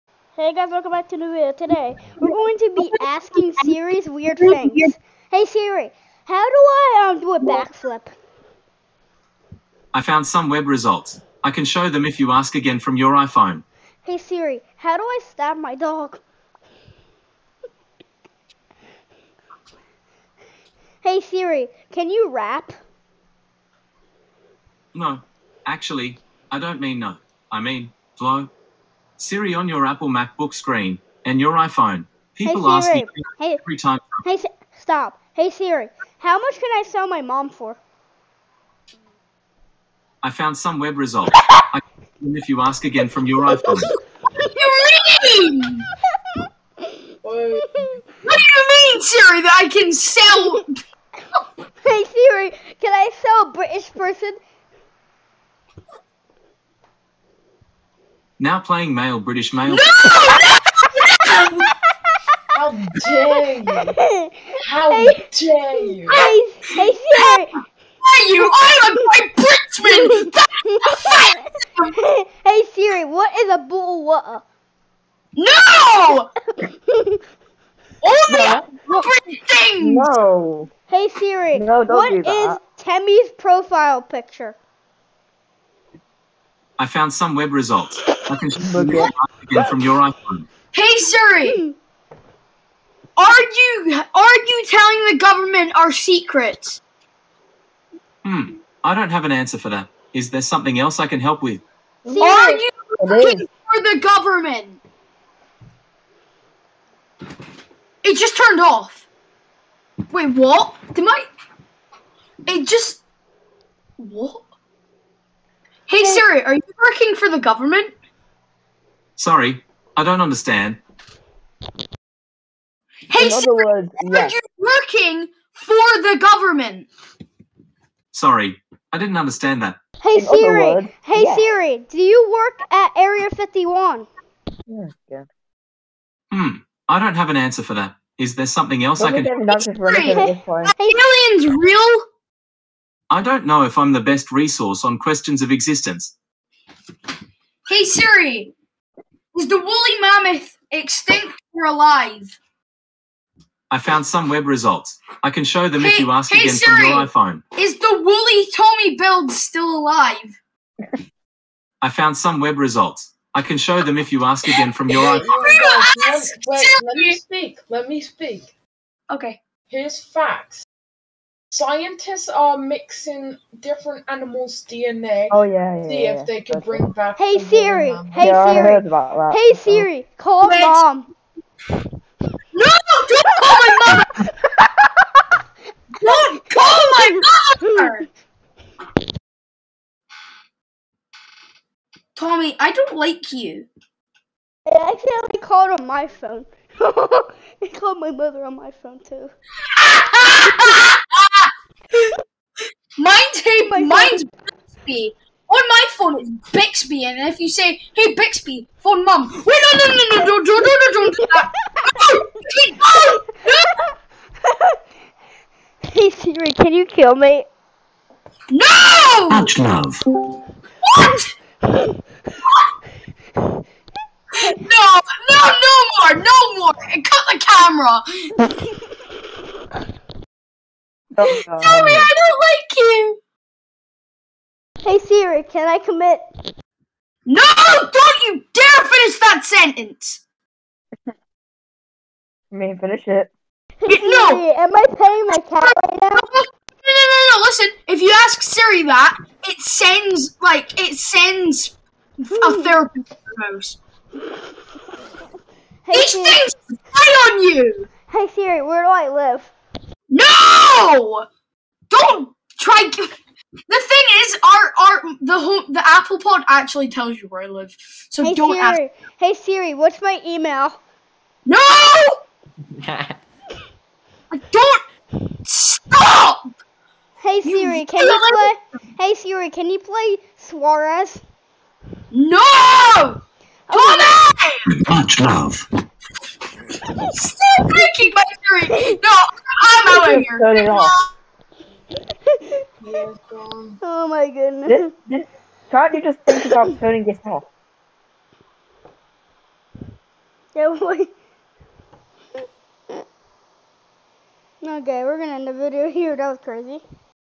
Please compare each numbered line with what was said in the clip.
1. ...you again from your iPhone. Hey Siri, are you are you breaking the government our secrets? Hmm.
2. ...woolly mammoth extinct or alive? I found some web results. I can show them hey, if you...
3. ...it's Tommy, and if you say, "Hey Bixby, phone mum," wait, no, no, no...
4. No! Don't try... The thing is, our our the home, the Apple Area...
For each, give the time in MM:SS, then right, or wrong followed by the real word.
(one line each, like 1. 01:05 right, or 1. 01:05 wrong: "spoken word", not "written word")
1. 01:28 wrong: "telling", not "breaking"
2. 02:29 right
3. 03:26 wrong: "Bixby", not "Tommy"
4. 04:20 wrong: "Pod", not "Area".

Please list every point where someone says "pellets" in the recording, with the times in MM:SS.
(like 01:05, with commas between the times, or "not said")
not said.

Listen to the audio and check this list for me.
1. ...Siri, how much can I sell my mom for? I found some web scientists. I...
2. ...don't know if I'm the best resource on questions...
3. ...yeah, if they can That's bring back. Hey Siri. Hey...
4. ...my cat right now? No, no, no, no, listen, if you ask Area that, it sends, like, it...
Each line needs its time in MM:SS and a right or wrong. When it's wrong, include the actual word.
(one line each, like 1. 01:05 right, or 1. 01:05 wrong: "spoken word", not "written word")
1. 00:35 wrong: "results", not "scientists"
2. 02:23 right
3. 02:56 right
4. 04:05 wrong: "Siri", not "Area".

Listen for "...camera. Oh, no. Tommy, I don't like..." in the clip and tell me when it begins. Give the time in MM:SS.
03:47.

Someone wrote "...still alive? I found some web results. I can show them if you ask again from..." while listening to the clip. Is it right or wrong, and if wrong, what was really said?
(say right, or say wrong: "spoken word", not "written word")
right.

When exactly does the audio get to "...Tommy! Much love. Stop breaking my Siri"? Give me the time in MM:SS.
04:43.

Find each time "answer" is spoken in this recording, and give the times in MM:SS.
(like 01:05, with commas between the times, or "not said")
01:39, 02:17.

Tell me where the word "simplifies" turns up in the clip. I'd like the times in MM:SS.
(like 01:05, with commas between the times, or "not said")
not said.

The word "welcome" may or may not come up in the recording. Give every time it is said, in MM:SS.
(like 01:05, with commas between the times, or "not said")
00:00.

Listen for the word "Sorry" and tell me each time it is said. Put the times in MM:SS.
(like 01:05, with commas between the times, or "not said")
01:59, 02:08.